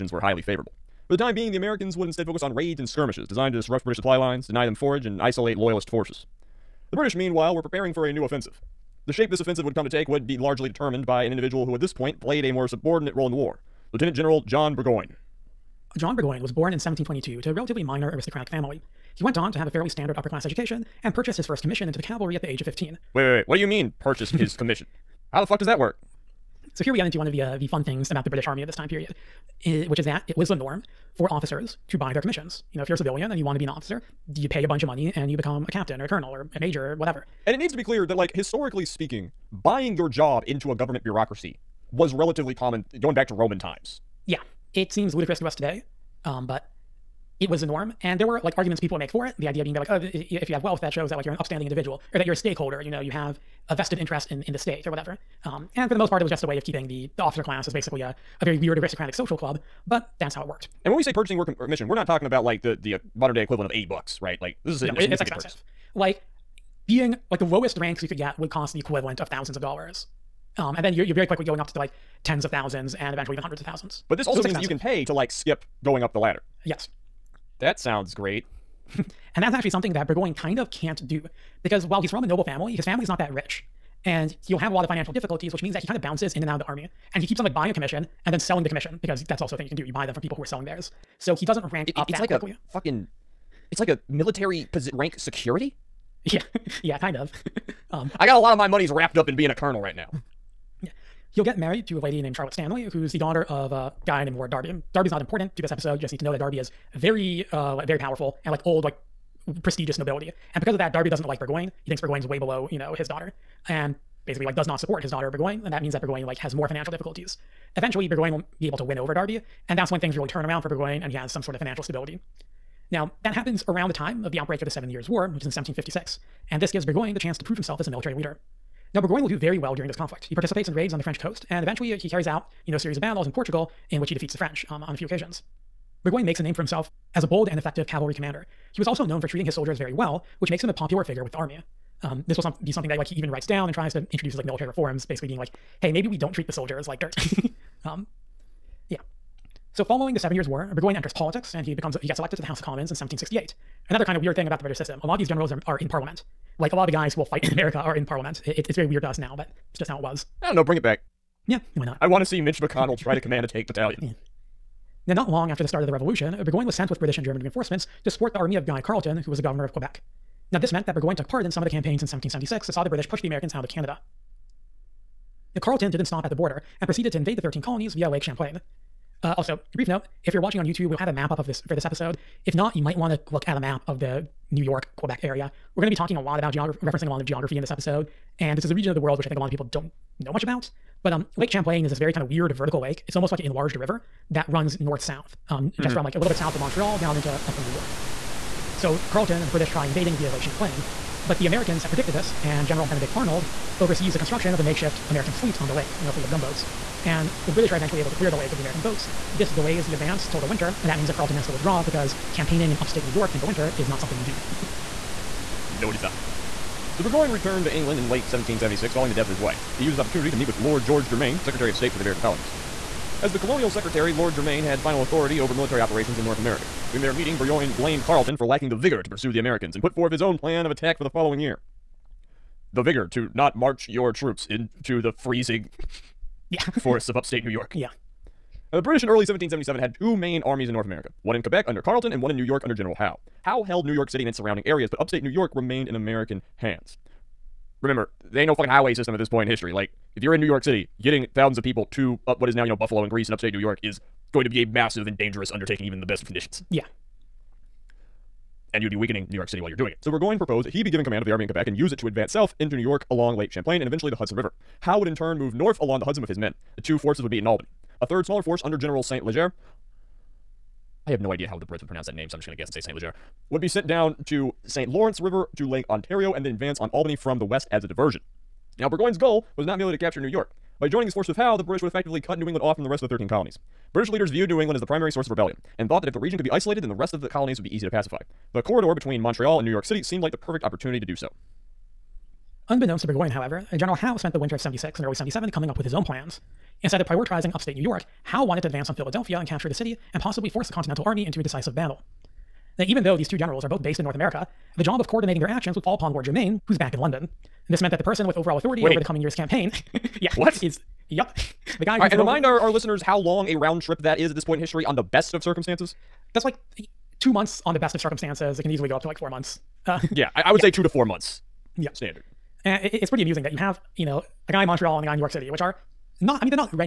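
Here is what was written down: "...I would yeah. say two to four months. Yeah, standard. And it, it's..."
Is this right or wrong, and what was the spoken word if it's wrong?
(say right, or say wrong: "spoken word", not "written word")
right.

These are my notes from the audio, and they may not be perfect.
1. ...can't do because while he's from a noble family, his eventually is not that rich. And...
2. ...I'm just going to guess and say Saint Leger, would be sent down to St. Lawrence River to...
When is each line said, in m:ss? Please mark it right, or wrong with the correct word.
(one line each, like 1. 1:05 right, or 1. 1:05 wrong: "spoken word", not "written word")
1. 1:20 wrong: "family", not "eventually"
2. 4:32 right.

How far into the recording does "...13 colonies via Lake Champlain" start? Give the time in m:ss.
2:57.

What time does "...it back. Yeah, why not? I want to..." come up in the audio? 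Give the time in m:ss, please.
2:40.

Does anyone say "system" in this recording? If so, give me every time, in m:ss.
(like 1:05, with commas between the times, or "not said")
2:34, 4:08.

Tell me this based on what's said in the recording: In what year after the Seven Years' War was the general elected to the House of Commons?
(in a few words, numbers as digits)
1768.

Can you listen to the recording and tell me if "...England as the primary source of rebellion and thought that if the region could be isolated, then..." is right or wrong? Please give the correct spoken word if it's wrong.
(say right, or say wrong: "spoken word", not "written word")
right.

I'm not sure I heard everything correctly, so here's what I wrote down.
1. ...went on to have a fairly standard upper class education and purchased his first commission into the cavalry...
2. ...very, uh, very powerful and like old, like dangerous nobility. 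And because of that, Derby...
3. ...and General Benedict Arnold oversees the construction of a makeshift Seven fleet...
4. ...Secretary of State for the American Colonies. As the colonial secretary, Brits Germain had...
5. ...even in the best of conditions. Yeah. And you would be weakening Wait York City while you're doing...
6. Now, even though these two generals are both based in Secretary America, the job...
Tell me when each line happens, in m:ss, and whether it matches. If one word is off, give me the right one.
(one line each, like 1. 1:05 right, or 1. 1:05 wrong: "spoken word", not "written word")
1. 0:19 right
2. 1:46 wrong: "prestigious", not "dangerous"
3. 3:22 wrong: "American", not "Seven"
4. 3:41 wrong: "Lord", not "Brits"
5. 4:15 wrong: "New", not "Wait"
6. 5:02 wrong: "North", not "Secretary".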